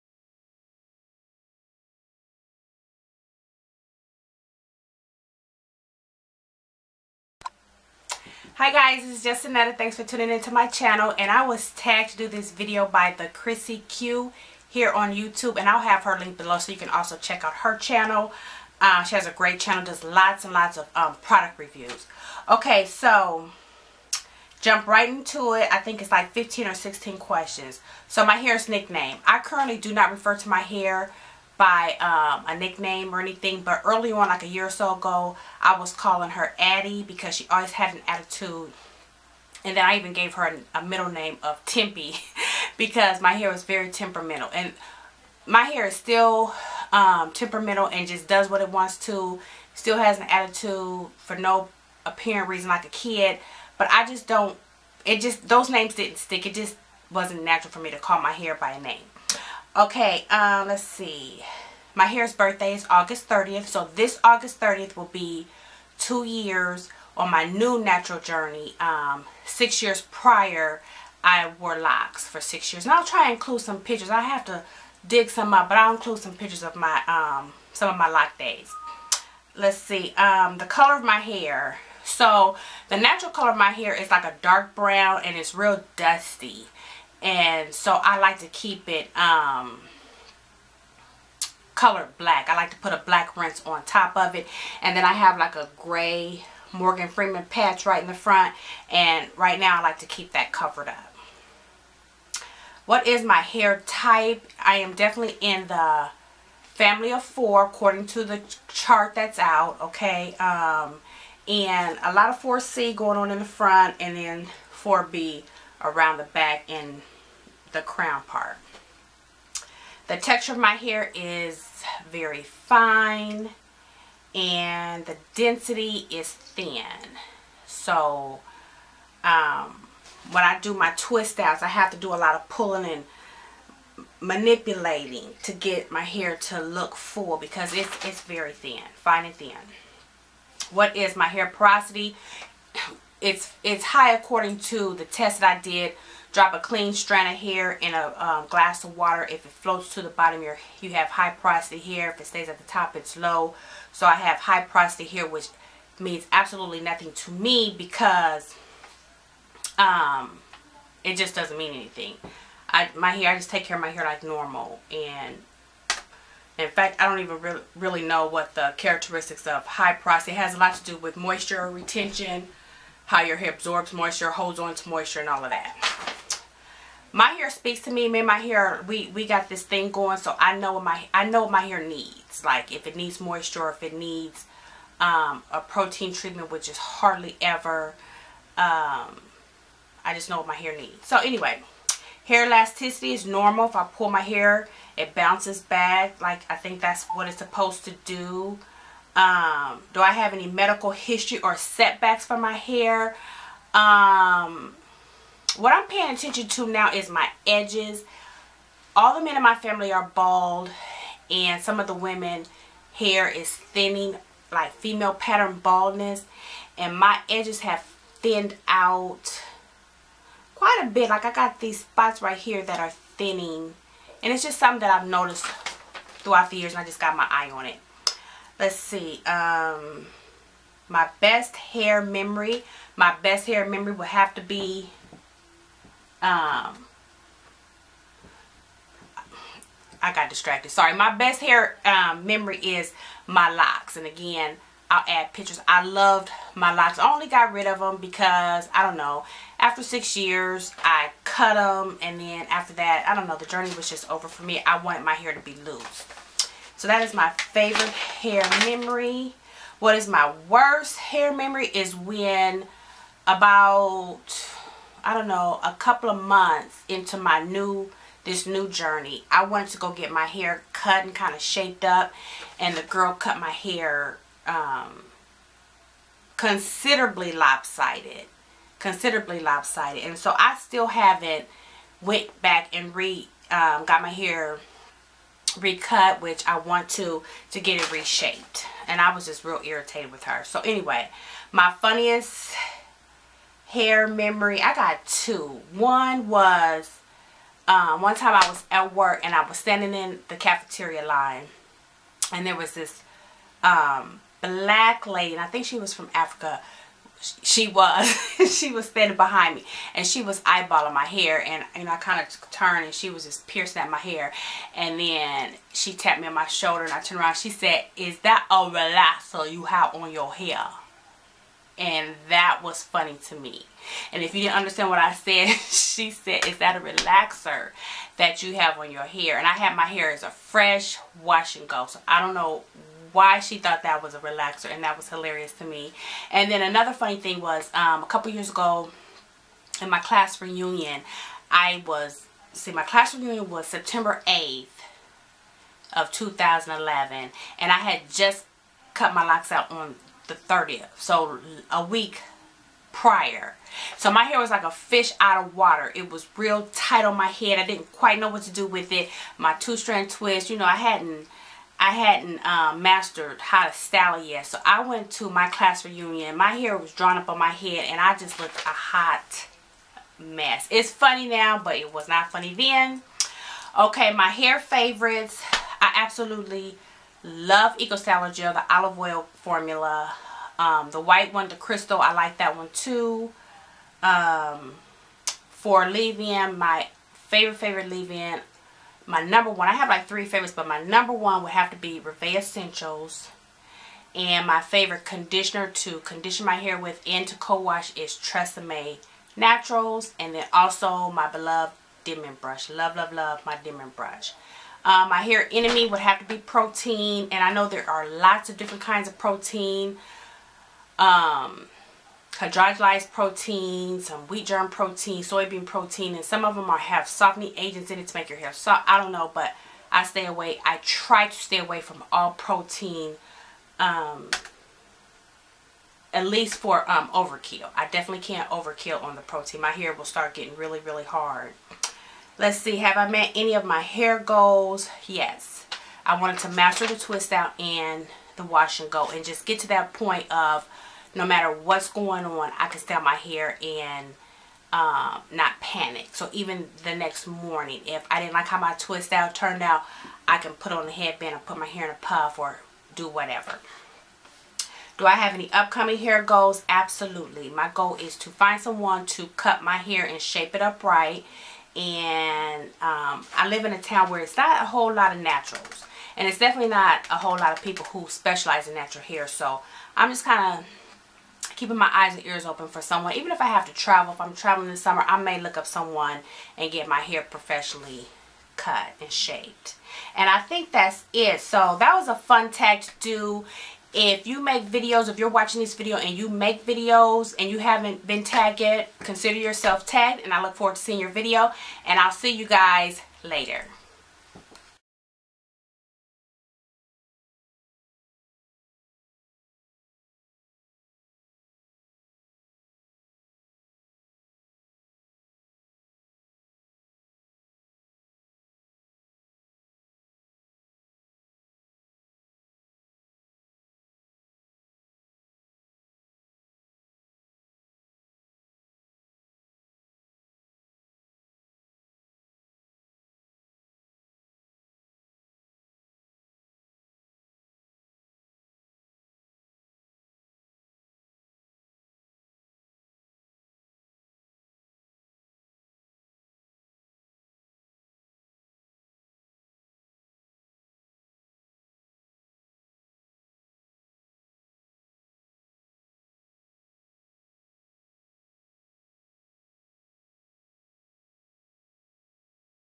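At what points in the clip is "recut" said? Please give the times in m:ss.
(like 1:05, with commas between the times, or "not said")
4:45.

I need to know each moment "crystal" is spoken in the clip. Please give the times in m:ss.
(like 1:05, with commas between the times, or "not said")
6:21.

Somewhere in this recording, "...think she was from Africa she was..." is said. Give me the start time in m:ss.
5:05.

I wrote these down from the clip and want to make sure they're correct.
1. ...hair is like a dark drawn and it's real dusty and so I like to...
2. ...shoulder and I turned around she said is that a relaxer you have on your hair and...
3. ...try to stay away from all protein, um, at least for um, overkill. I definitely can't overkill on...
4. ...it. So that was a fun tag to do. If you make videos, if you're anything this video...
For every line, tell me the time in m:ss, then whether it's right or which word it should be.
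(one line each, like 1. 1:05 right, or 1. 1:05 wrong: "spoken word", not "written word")
1. 1:23 wrong: "brown", not "drawn"
2. 5:16 right
3. 7:00 right
4. 8:01 wrong: "watching", not "anything".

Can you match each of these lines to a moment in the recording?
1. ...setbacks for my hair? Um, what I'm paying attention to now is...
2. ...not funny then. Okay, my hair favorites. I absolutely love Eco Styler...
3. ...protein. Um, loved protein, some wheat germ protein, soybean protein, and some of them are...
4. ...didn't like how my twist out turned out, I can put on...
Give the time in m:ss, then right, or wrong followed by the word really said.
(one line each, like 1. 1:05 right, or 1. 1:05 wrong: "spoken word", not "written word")
1. 3:21 right
2. 6:12 right
3. 6:49 wrong: "hydrolyzed", not "loved"
4. 7:28 right.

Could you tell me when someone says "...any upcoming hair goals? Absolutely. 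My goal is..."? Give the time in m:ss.
7:35.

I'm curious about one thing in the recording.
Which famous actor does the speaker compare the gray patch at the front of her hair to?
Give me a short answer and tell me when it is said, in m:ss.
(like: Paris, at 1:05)
Morgan Freeman, at 1:36.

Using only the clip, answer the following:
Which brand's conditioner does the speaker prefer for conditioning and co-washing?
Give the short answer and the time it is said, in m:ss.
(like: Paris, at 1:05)
Tresemme Naturals, at 6:38.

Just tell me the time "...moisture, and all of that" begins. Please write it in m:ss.
2:54.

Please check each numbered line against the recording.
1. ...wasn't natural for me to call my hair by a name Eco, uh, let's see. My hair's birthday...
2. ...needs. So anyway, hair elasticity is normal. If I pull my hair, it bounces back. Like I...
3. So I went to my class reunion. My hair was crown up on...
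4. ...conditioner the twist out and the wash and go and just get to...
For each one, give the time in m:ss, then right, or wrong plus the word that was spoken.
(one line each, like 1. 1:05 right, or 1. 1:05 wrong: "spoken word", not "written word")
1. 0:57 wrong: "Okay", not "Eco"
2. 3:10 right
3. 6:04 wrong: "drawn", not "crown"
4. 7:16 wrong: "master", not "conditioner".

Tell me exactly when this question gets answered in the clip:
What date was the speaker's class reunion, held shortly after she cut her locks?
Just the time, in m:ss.
5:43.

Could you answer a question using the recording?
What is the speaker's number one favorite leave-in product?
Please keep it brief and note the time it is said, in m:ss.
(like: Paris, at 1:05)
Revee Essentials, at 6:31.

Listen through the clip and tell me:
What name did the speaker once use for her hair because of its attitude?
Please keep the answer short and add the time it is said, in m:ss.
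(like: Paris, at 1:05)
Addie, at 0:36.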